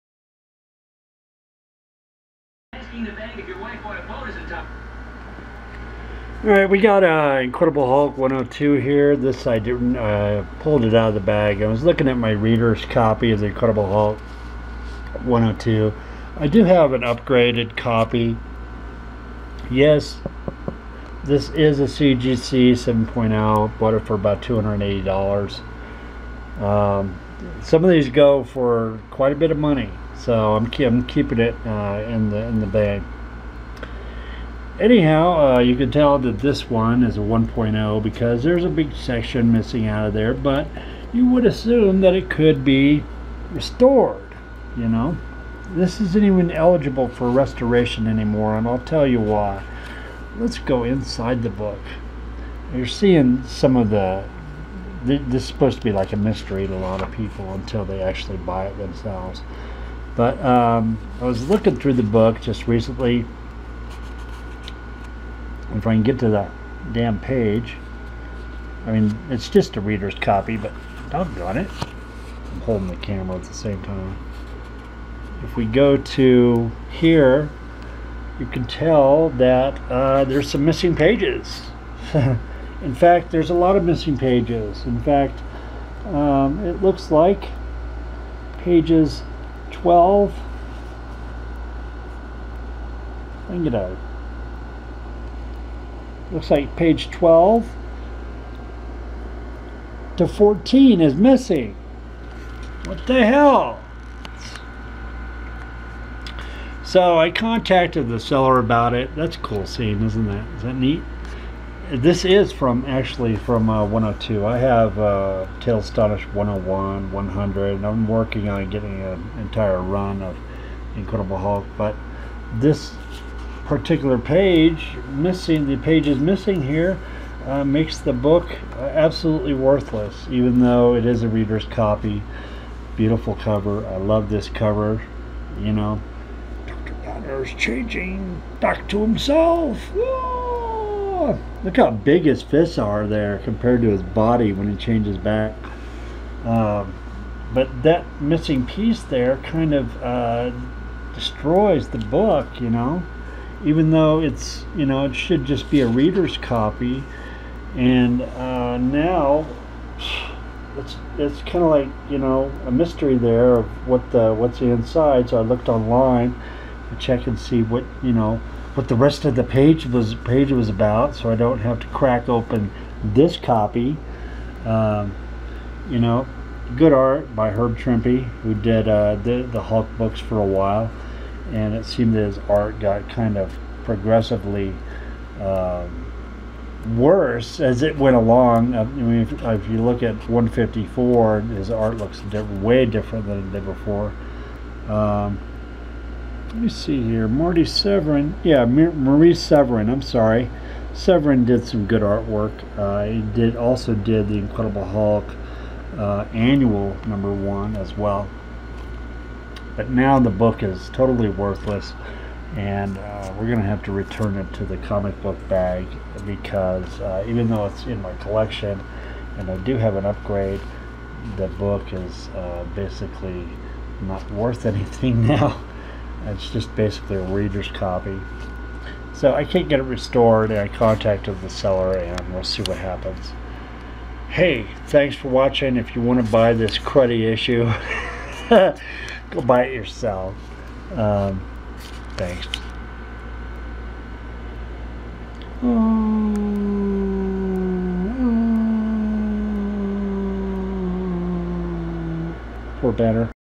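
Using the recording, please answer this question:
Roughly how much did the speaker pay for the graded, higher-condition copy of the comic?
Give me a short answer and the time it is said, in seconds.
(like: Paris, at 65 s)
$280, at 24 s.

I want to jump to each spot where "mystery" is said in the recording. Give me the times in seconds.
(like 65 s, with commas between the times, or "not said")
56 s, 162 s.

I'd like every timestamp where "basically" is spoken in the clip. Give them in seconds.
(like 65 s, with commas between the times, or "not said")
222 s, 226 s.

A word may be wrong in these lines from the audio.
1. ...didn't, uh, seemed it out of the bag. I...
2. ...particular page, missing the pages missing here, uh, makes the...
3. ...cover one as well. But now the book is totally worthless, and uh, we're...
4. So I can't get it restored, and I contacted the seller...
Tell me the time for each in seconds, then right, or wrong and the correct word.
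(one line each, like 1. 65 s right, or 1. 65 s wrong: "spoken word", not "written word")
1. 9 s wrong: "pulled", not "seemed"
2. 123 s right
3. 207 s wrong: "number", not "cover"
4. 229 s right.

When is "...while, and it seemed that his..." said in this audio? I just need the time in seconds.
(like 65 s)
180 s.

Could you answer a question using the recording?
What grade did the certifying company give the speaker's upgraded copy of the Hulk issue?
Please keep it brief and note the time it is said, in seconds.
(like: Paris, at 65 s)
7.0, at 22 s.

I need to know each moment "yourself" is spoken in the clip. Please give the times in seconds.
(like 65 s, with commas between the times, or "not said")
239 s.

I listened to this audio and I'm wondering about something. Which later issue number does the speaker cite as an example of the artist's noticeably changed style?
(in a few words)
154.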